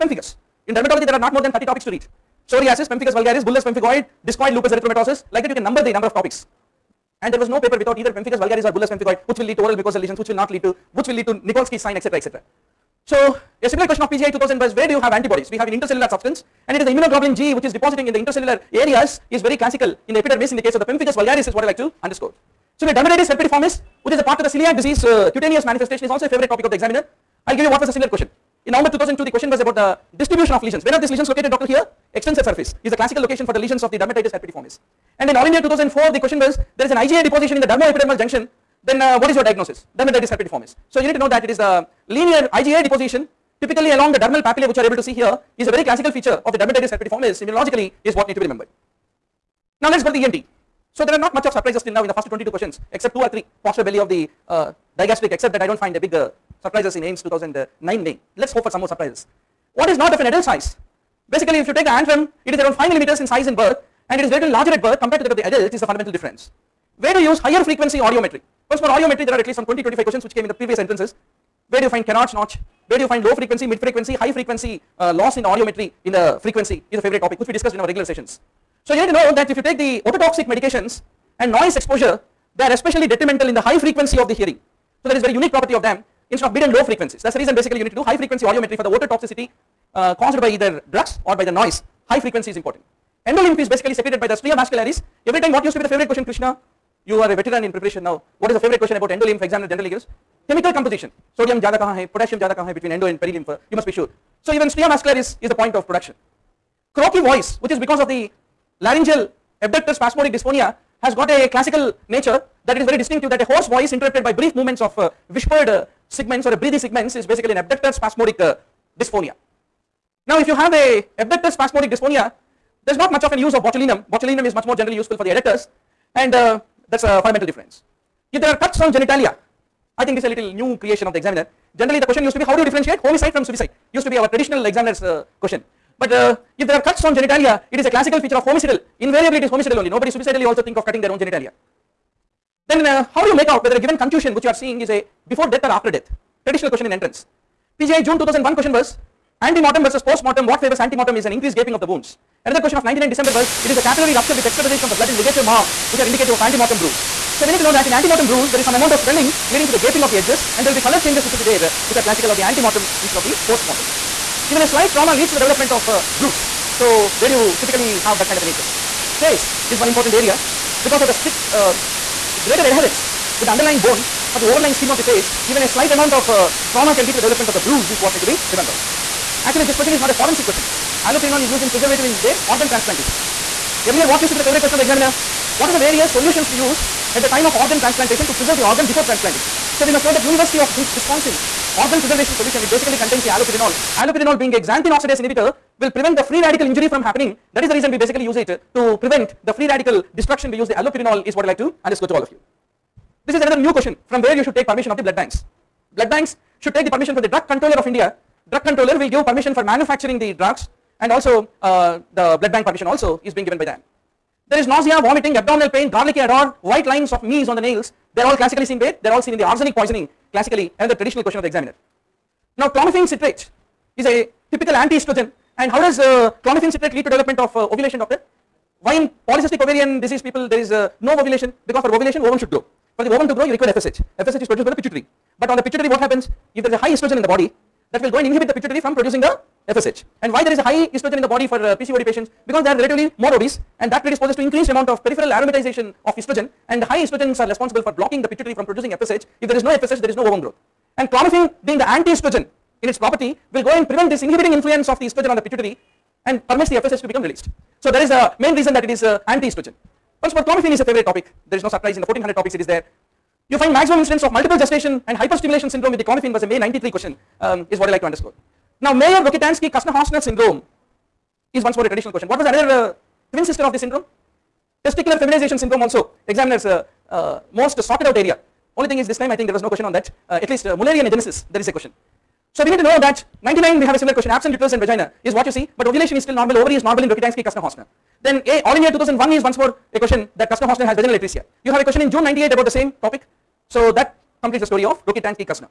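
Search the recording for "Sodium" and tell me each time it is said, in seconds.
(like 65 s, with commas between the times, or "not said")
101 s.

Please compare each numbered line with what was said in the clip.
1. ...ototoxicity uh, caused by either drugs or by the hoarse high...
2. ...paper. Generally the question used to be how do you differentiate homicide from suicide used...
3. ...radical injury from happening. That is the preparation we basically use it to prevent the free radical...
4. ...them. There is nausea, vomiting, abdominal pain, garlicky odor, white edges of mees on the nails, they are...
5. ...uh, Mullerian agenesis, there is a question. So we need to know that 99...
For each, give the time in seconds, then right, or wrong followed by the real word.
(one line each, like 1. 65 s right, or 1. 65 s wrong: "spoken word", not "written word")
1. 88 s wrong: "noise", not "hoarse"
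2. 131 s wrong: "examiner", not "paper"
3. 196 s wrong: "reason", not "preparation"
4. 213 s wrong: "lines", not "edges"
5. 280 s right.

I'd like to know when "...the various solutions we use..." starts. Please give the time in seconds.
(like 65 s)
185 s.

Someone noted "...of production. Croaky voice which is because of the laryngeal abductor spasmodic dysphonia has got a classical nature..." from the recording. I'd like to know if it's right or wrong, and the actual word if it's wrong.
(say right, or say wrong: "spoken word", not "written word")
right.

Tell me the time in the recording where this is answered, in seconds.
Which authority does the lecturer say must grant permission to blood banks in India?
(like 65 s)
207 s.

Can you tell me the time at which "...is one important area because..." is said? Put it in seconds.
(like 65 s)
169 s.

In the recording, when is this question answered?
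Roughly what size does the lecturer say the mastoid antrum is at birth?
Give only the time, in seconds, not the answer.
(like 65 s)
62 s.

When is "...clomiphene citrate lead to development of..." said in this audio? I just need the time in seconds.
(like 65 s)
226 s.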